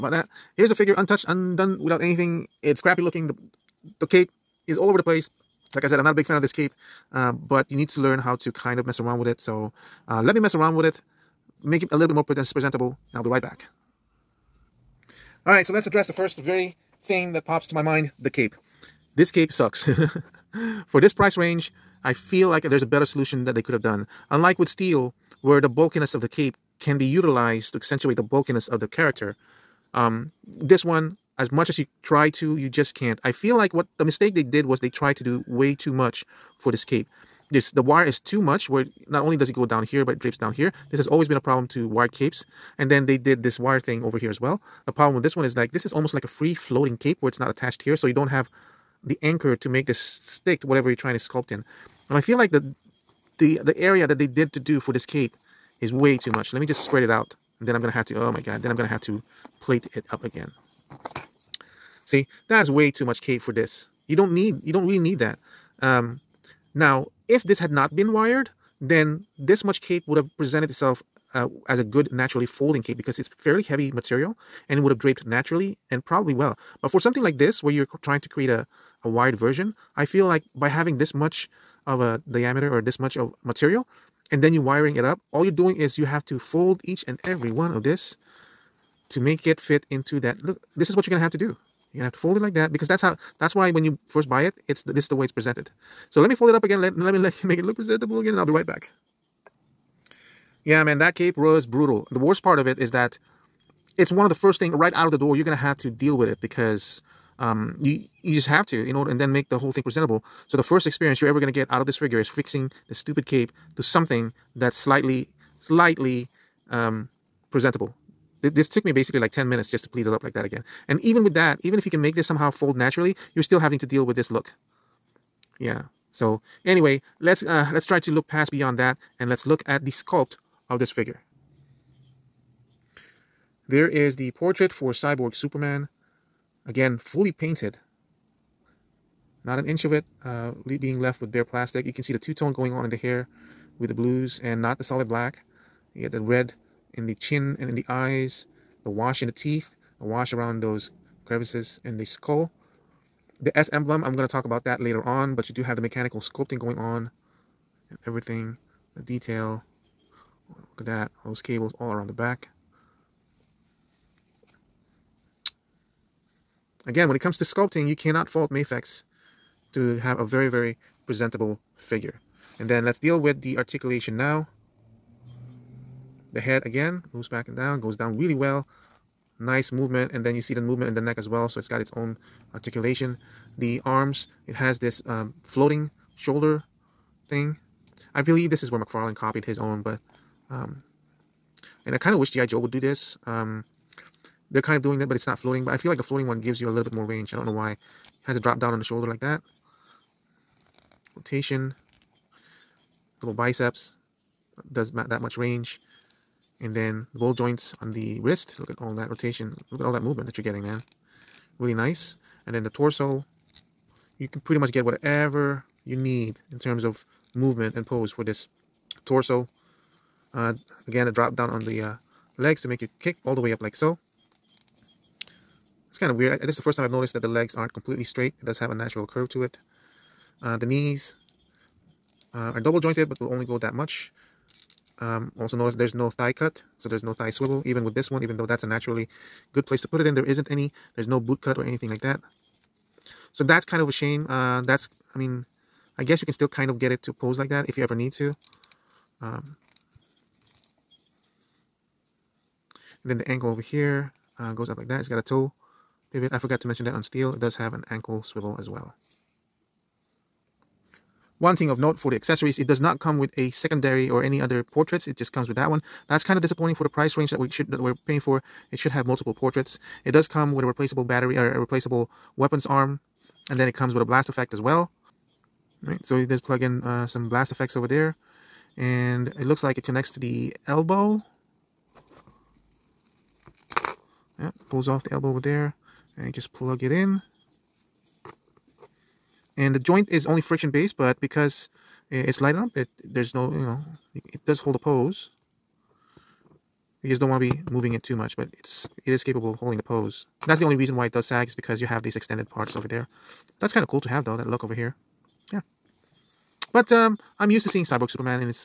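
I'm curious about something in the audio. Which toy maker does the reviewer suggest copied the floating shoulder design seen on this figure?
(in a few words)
McFarlane.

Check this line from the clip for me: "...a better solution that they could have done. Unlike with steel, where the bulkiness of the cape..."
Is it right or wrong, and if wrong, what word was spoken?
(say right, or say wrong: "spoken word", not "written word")
right.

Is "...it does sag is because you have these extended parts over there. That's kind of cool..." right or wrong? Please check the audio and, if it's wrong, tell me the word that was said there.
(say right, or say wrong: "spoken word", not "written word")
right.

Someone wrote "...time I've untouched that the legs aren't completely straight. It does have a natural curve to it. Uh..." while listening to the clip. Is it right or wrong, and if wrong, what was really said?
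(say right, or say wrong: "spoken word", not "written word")
wrong: "noticed", not "untouched".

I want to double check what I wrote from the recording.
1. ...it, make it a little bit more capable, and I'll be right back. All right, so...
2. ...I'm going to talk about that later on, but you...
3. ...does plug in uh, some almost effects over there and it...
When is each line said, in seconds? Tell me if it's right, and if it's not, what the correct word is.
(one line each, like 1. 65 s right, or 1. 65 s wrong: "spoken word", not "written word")
1. 10 s wrong: "presentable", not "capable"
2. 154 s right
3. 276 s wrong: "blast", not "almost".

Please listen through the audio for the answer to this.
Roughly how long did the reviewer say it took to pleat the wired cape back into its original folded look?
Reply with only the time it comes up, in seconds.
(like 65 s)
119 s.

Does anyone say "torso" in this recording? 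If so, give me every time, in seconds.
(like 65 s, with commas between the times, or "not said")
212 s, 219 s.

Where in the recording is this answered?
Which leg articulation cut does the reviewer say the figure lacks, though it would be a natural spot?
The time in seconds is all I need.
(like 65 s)
236 s.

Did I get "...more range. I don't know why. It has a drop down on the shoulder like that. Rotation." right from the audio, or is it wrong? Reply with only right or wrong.
right.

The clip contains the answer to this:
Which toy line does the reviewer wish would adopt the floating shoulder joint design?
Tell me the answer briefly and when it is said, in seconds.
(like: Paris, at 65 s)
G.I. Joe, at 192 s.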